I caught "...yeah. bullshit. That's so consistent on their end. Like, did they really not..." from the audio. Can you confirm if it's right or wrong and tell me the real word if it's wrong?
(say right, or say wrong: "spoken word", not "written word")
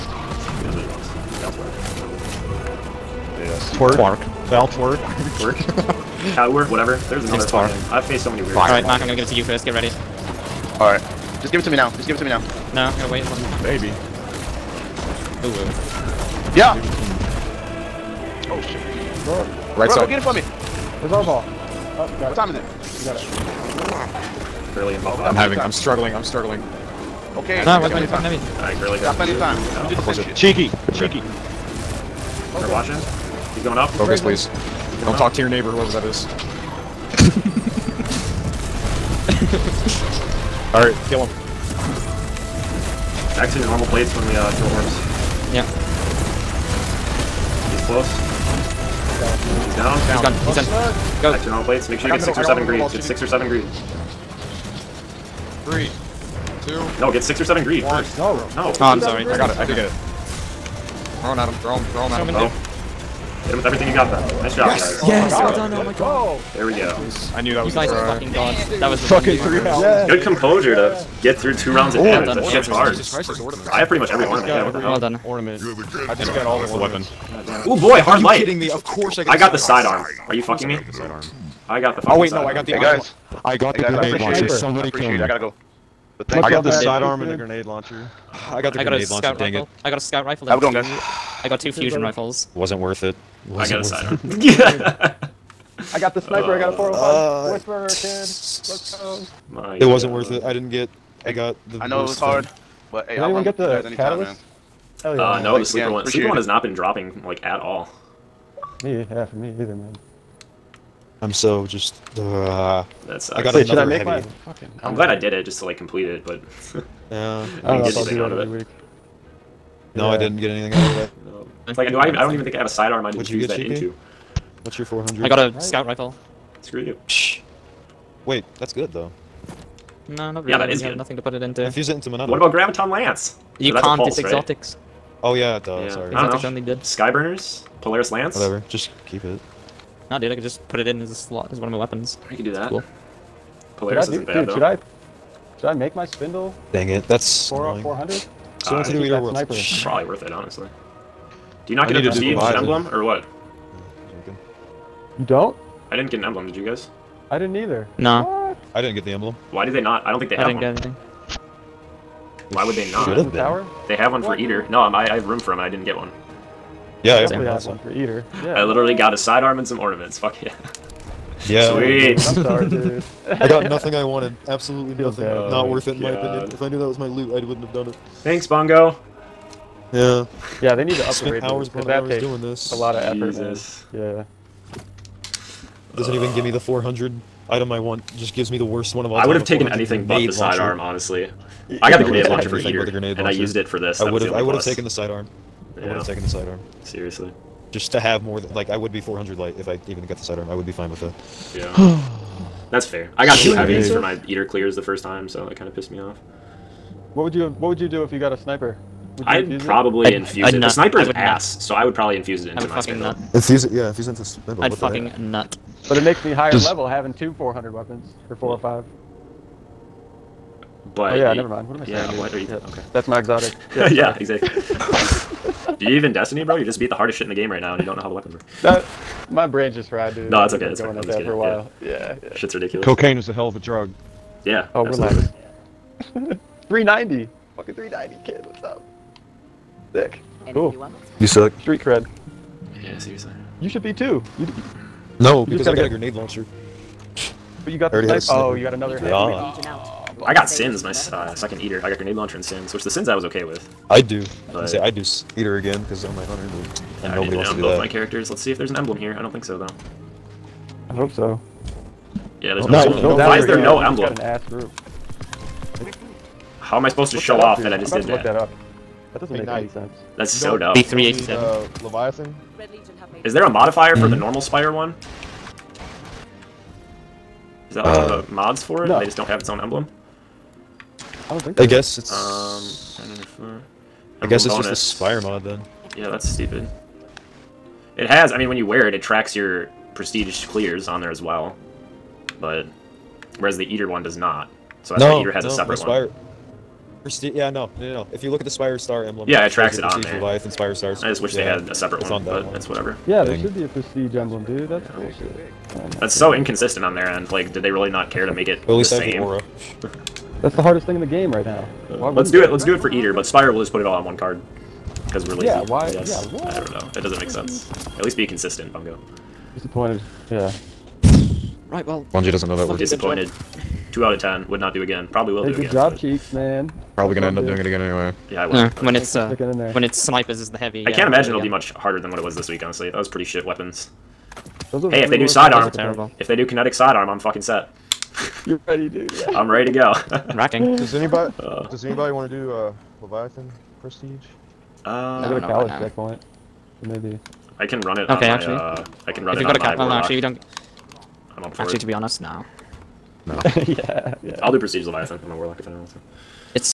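wrong: "inconsistent", not "consistent".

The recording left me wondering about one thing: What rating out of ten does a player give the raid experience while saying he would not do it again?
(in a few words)
2 out of 10.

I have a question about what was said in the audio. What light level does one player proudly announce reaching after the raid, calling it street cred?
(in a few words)
390.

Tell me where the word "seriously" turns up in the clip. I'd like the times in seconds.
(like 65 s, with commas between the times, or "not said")
196 s, 242 s.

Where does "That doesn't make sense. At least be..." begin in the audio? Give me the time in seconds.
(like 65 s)
316 s.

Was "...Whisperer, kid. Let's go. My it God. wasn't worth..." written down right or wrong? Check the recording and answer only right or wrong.
right.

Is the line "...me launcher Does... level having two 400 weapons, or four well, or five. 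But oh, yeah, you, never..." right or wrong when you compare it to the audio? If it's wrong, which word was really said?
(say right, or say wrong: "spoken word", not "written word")
wrong: "higher", not "launcher".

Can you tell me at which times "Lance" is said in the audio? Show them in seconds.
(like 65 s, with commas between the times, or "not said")
132 s, 138 s.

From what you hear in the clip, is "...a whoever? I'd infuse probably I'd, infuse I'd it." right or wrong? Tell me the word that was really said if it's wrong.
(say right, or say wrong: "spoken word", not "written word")
wrong: "sniper", not "whoever".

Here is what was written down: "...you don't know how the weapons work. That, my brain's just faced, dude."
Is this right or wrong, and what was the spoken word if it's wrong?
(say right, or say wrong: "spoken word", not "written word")
wrong: "fried", not "faced".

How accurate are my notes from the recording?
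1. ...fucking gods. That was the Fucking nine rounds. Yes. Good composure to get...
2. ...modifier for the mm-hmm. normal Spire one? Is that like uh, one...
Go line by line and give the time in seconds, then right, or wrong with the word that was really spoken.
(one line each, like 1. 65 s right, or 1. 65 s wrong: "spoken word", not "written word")
1. 68 s wrong: "three", not "nine"
2. 273 s right.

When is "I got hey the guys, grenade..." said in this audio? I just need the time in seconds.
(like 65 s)
83 s.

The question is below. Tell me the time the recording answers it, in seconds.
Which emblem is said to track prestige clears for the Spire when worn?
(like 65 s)
300 s.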